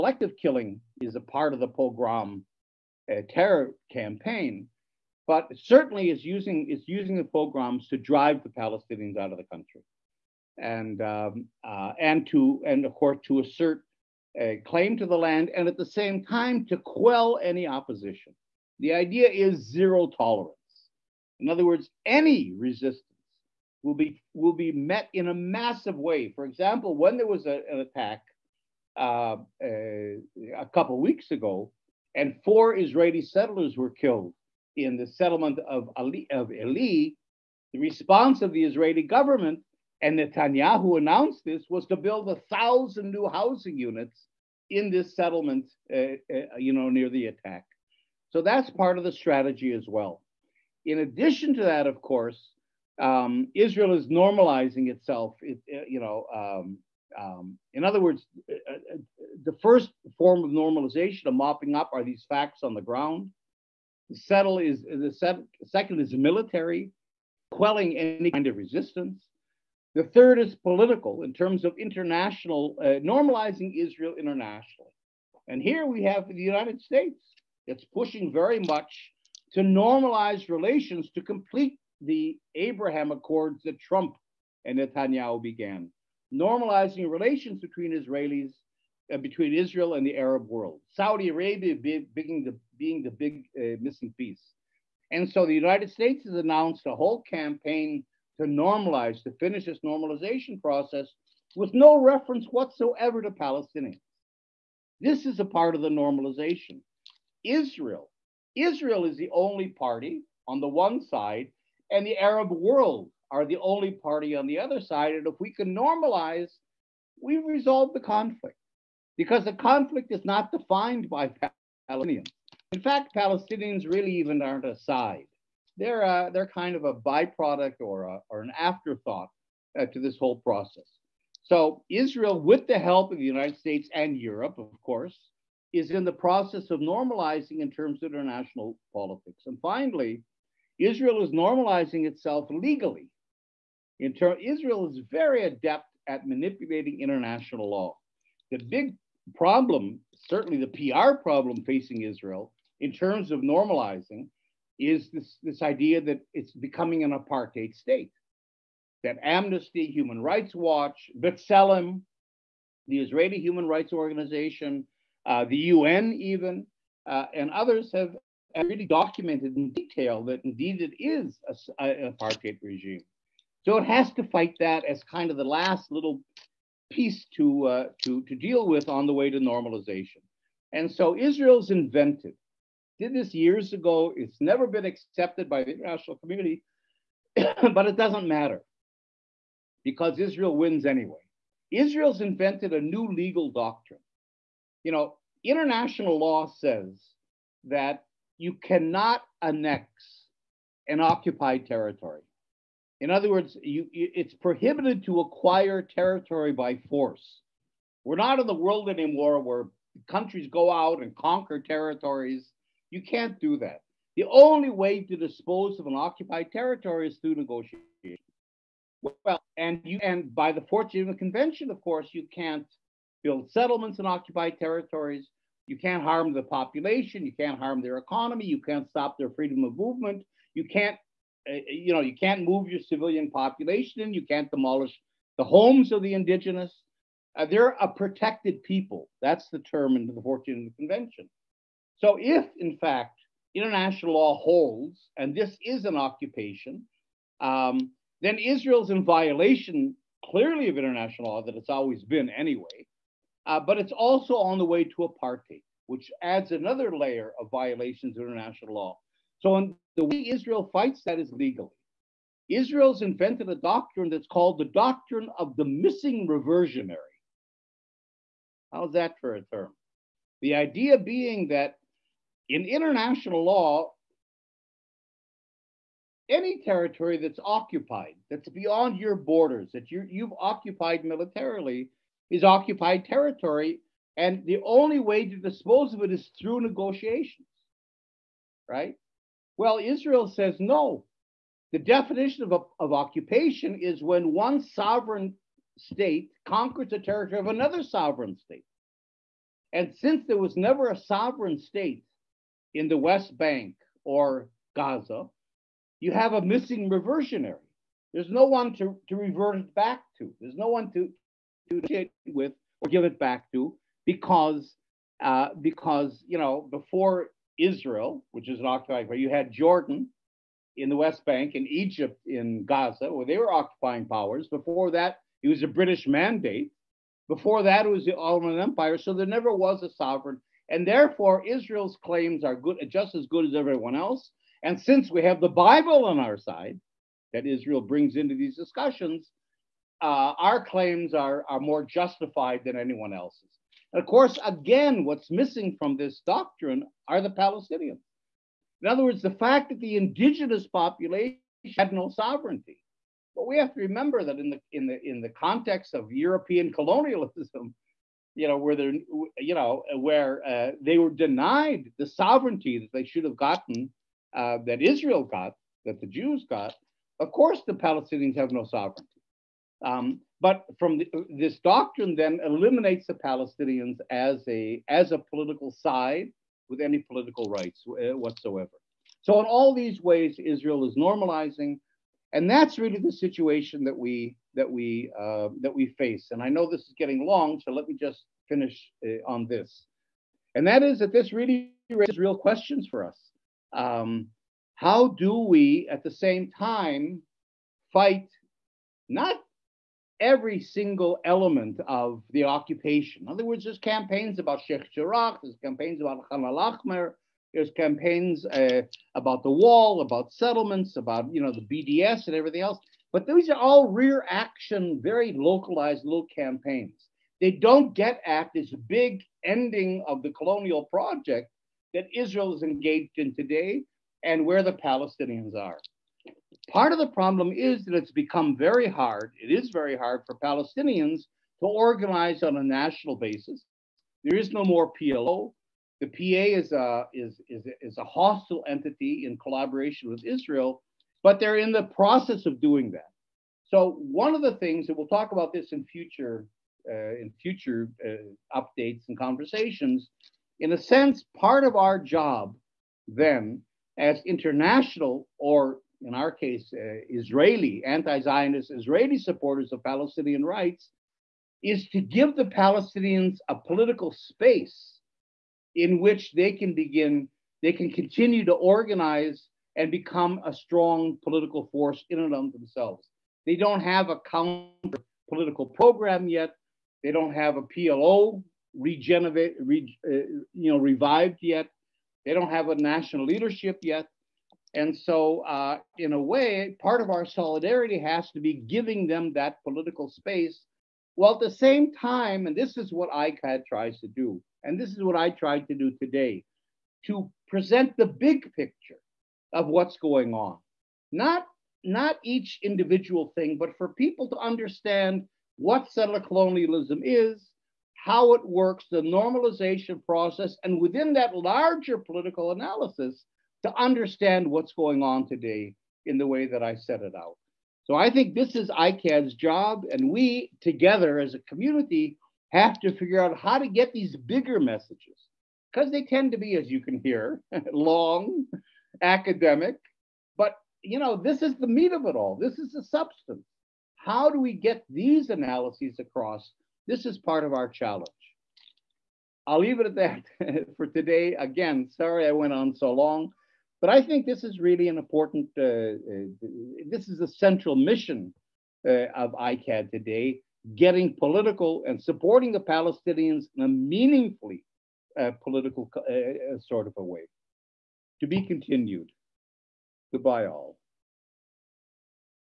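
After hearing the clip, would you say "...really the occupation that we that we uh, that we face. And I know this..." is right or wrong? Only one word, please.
wrong.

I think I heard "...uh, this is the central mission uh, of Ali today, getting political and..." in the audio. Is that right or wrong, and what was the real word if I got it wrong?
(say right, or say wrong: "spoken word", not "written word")
wrong: "ICAHD", not "Ali".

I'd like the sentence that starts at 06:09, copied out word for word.
Um, but from the, this doctrine then eliminates the Palestinians as a as a political side with any political rights uh, whatsoever.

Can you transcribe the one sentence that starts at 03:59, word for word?
That's the term in the Fourth Convention.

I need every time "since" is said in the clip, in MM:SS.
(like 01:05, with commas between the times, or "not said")
05:00, 05:34.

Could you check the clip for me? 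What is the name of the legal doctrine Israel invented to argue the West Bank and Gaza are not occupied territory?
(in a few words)
Doctrine of the missing reversionary.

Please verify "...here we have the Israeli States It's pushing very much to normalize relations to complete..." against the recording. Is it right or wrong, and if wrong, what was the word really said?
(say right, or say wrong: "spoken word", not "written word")
wrong: "United", not "Israeli".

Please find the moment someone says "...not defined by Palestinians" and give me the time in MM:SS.
02:00.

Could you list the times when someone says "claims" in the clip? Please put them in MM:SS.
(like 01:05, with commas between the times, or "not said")
00:14, 05:32, 05:40.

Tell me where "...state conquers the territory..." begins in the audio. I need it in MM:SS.
04:55.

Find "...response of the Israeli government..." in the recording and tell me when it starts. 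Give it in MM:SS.
00:37.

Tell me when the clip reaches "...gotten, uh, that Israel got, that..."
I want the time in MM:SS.
06:03.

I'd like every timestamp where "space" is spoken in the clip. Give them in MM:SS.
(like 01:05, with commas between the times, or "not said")
07:44, 08:10.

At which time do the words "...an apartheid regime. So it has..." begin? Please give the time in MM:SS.
02:51.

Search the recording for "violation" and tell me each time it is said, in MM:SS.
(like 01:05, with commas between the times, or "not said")
04:09, 04:17.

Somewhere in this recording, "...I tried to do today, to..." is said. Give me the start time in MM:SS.
08:15.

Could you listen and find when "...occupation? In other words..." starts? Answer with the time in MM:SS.
06:42.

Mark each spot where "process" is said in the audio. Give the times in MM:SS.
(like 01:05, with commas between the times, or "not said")
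01:40, 02:10, 02:16, 07:21, 08:30.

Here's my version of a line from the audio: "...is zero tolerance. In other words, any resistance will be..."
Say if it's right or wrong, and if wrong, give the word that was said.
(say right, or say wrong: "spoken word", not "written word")
right.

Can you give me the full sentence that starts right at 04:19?
So, in the way Israel fights that is legally.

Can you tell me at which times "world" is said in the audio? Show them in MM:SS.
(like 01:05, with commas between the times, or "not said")
01:30, 01:52, 03:28.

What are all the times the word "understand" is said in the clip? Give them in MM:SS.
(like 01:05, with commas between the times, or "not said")
08:24, 08:33.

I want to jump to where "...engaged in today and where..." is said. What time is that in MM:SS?
07:02.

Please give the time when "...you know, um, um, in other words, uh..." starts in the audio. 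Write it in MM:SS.
00:55.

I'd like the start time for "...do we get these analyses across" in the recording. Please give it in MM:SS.
08:54.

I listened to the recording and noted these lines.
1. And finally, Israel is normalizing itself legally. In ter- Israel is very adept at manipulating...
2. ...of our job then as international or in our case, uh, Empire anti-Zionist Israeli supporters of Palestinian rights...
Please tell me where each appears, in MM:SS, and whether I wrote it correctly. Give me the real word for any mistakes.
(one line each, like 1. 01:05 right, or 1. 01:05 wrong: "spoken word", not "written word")
1. 02:19 right
2. 07:31 wrong: "Israeli", not "Empire".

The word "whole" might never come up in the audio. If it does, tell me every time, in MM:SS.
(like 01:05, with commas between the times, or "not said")
01:37, 02:10.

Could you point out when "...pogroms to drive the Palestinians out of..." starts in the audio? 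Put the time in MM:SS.
00:07.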